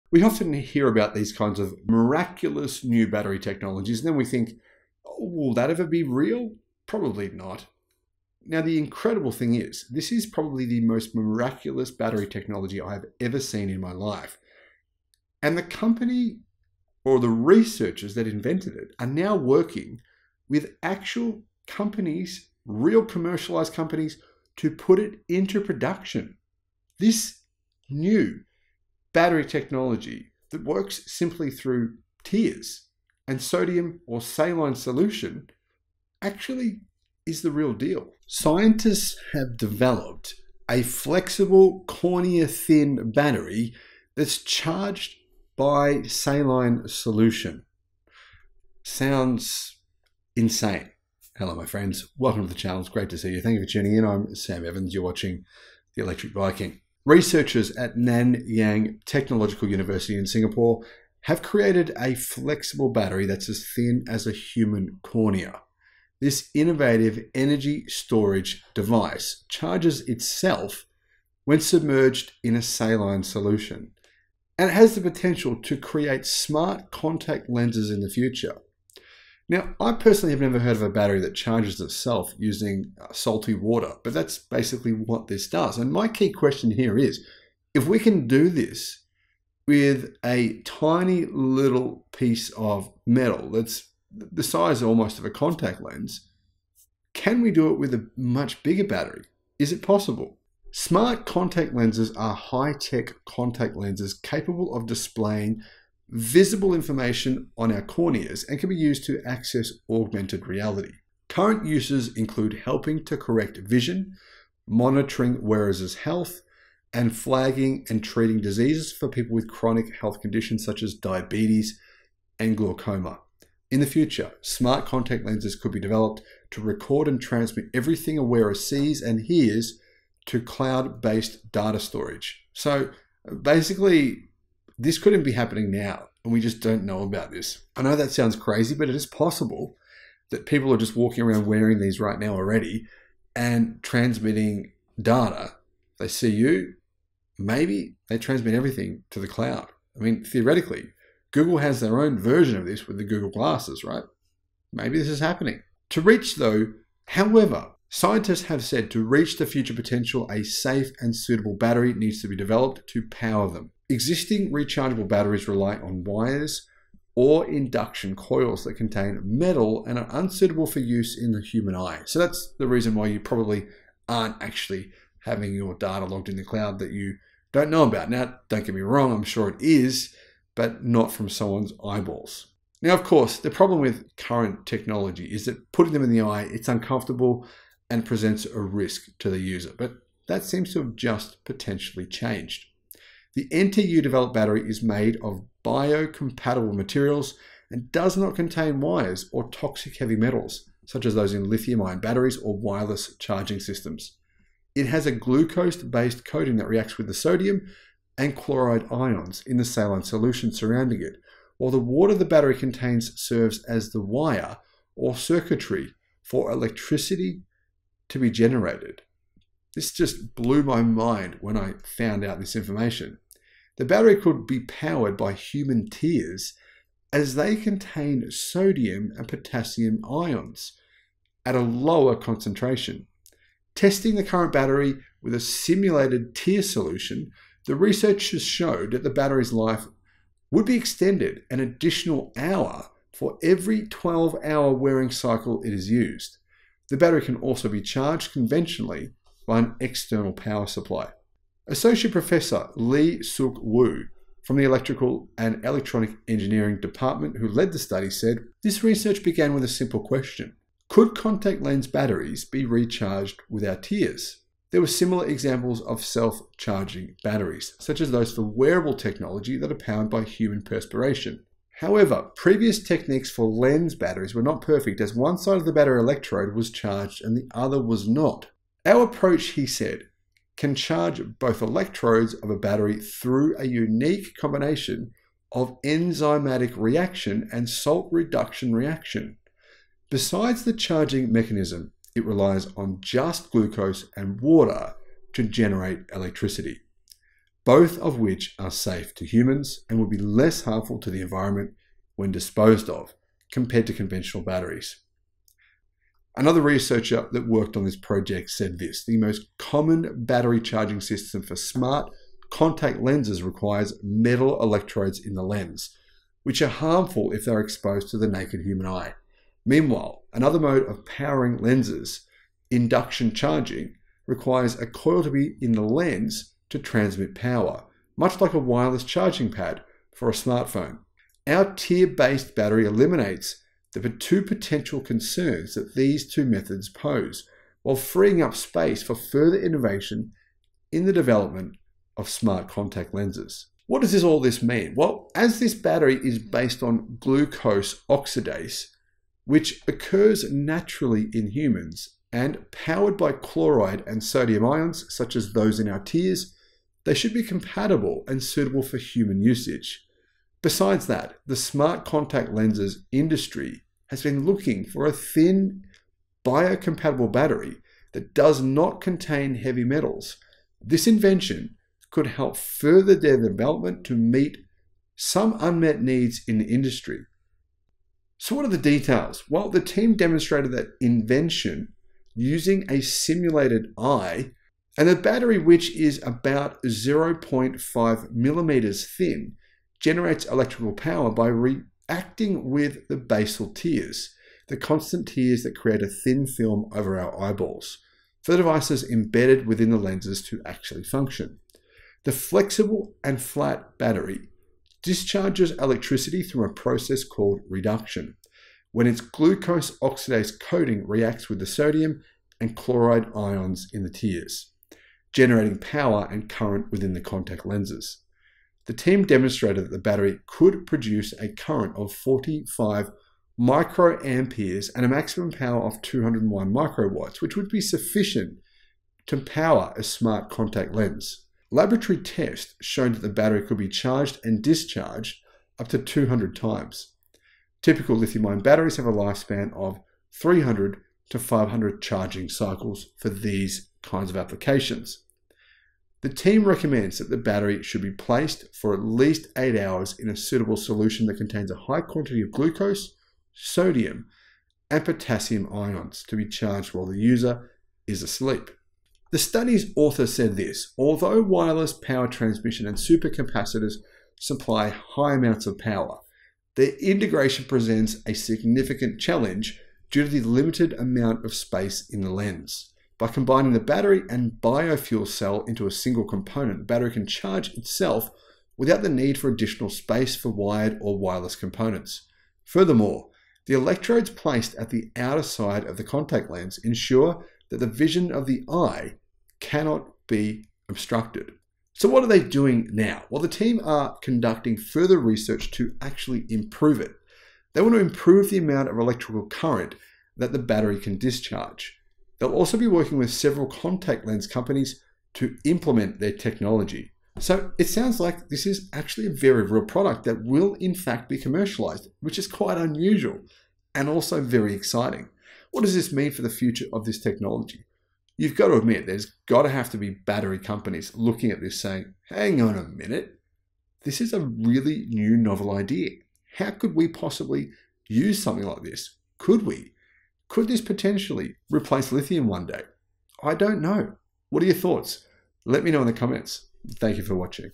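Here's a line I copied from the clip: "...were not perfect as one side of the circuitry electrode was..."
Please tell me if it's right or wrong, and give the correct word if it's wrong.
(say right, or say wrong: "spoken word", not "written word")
wrong: "battery", not "circuitry".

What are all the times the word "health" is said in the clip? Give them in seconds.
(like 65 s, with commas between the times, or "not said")
115 s, 120 s.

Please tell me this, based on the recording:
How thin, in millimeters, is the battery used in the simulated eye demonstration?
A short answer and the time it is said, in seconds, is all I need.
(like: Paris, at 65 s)
0.5 millimeters, at 386 s.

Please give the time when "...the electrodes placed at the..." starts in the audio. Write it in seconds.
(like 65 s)
483 s.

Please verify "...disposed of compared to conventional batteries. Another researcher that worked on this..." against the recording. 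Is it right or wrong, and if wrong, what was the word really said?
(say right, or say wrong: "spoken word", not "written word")
right.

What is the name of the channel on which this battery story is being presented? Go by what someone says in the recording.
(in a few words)
The Electric Viking.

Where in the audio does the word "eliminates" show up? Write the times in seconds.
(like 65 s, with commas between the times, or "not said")
332 s.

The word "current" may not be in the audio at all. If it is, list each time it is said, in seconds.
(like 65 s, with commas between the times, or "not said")
111 s, 184 s, 234 s, 416 s, 421 s, 499 s.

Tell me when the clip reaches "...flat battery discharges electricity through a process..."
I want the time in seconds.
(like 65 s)
403 s.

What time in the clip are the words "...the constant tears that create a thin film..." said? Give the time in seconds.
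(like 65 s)
394 s.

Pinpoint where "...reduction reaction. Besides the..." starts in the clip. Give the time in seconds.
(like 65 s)
288 s.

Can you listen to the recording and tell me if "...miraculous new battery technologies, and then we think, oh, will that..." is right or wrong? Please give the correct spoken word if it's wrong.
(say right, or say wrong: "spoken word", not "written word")
right.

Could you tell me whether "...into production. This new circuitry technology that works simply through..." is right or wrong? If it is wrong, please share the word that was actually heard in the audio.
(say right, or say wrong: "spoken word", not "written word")
wrong: "battery", not "circuitry".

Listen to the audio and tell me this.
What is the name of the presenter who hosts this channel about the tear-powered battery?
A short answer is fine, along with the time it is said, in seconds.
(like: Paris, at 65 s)
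Sam Evans, at 54 s.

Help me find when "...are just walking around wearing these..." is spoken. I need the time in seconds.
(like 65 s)
140 s.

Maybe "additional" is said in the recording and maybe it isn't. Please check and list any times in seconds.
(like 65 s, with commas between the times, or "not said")
241 s, 479 s.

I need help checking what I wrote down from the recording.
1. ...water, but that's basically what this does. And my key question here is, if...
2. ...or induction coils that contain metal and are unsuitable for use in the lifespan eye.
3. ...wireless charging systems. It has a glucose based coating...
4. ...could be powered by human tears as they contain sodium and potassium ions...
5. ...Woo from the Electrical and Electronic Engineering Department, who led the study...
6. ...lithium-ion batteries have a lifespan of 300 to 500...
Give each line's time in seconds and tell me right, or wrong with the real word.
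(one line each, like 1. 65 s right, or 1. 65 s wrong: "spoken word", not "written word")
1. 83 s right
2. 167 s wrong: "human", not "lifespan"
3. 202 s right
4. 224 s right
5. 253 s right
6. 438 s right.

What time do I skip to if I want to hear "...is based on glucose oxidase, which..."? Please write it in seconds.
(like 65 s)
346 s.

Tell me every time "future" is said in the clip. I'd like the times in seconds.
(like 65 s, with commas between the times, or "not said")
78 s, 123 s, 159 s, 516 s.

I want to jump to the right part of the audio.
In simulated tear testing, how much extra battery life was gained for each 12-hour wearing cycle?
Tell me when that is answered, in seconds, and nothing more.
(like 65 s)
241 s.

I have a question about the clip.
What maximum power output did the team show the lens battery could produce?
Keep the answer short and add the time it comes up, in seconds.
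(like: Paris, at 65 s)
201 microwatts, at 426 s.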